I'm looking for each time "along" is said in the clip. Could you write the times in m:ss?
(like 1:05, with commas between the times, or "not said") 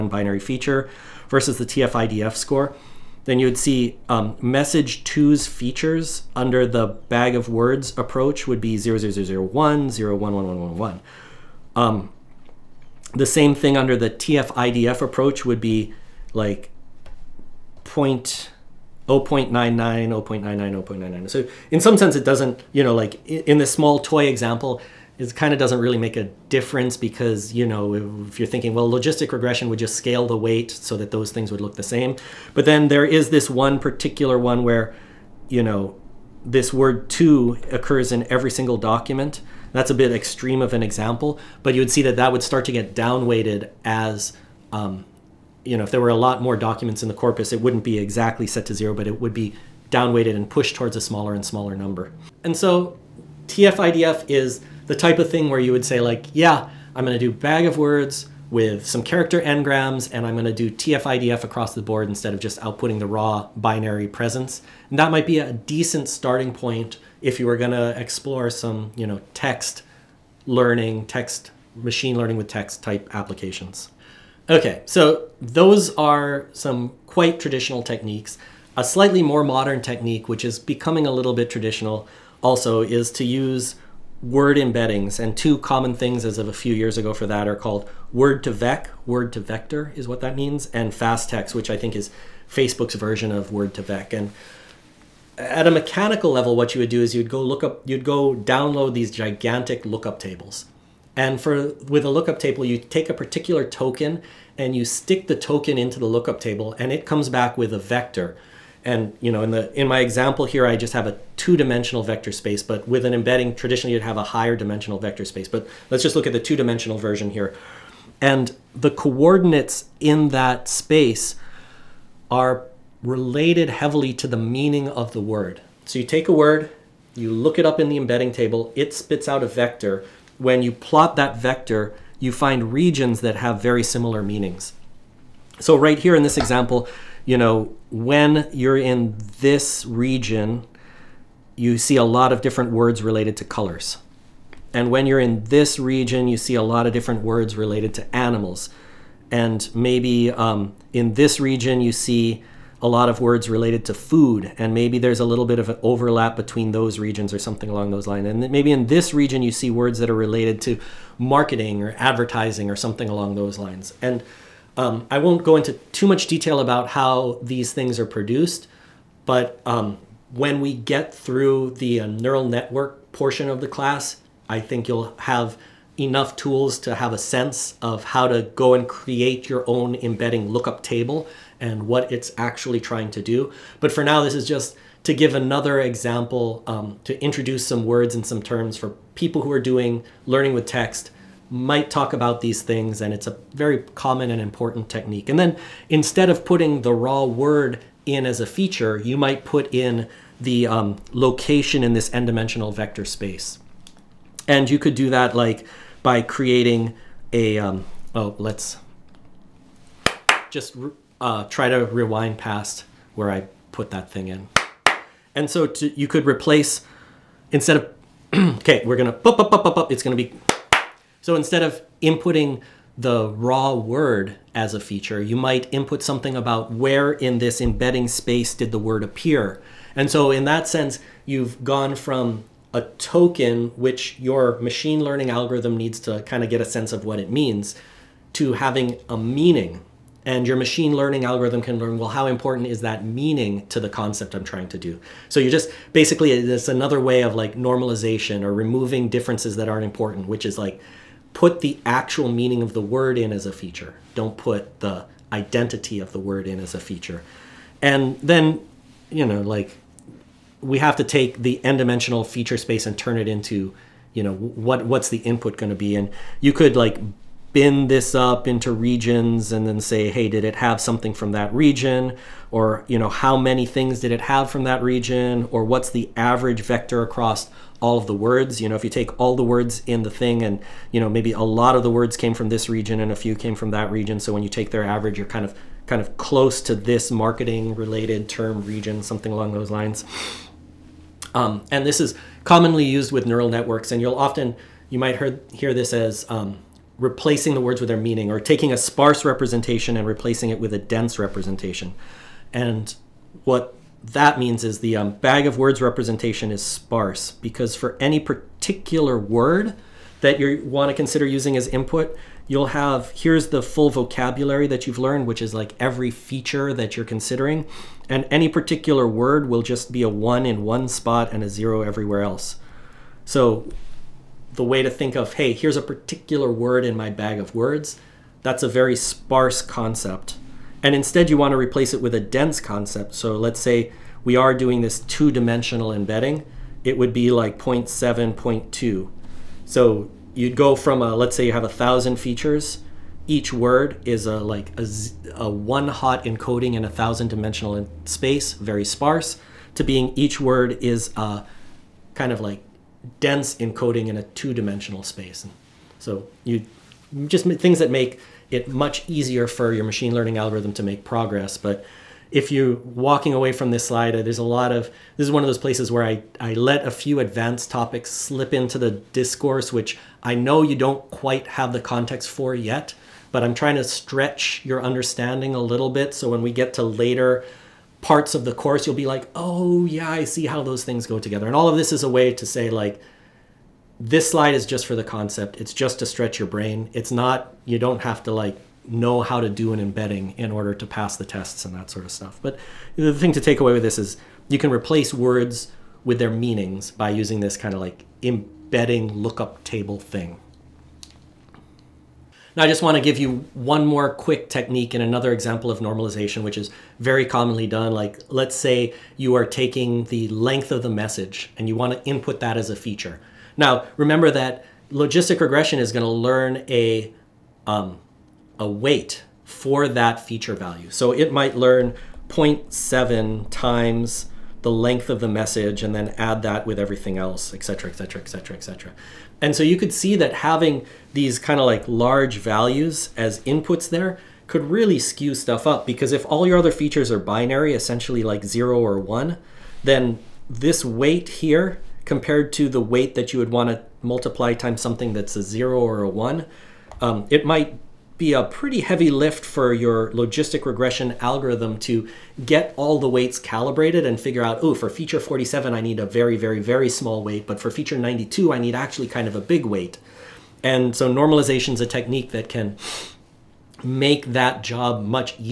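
2:37, 2:43, 4:49.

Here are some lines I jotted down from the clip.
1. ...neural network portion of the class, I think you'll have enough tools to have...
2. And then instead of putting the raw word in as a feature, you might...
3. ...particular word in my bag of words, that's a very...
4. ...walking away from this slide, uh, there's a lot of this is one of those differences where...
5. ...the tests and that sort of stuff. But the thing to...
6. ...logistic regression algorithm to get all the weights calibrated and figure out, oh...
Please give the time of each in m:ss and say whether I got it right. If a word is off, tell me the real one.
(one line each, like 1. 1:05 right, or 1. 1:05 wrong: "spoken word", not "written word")
1. 2:52 right
2. 3:15 right
3. 5:25 right
4. 6:02 wrong: "places", not "differences"
5. 6:31 right
6. 7:30 right.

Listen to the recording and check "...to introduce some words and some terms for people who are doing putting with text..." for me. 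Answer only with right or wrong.
wrong.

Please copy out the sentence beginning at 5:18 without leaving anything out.
And any particular word will just be a one in one spot and a zero everywhere else.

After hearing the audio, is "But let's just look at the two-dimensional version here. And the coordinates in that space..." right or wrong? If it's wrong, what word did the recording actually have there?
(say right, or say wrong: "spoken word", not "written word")
right.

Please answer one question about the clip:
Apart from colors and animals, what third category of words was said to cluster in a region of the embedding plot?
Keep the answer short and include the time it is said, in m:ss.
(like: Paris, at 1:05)
food, at 2:33.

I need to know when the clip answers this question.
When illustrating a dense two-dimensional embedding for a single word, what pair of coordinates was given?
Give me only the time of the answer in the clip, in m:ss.
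5:37.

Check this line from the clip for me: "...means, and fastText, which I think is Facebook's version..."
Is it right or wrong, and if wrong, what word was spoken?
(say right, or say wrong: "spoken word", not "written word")
right.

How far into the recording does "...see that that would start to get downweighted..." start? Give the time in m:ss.
0:41.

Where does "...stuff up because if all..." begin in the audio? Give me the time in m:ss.
7:15.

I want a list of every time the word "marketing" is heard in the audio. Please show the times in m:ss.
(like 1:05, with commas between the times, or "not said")
2:41, 4:47.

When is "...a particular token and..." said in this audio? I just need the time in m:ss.
1:43.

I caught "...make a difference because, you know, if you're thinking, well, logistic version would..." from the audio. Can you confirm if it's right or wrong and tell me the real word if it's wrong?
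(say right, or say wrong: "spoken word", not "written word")
wrong: "regression", not "version".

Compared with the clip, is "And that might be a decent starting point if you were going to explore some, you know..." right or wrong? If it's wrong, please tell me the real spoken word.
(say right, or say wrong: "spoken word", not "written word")
right.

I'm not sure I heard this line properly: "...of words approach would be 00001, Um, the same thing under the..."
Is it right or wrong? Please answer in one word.
right.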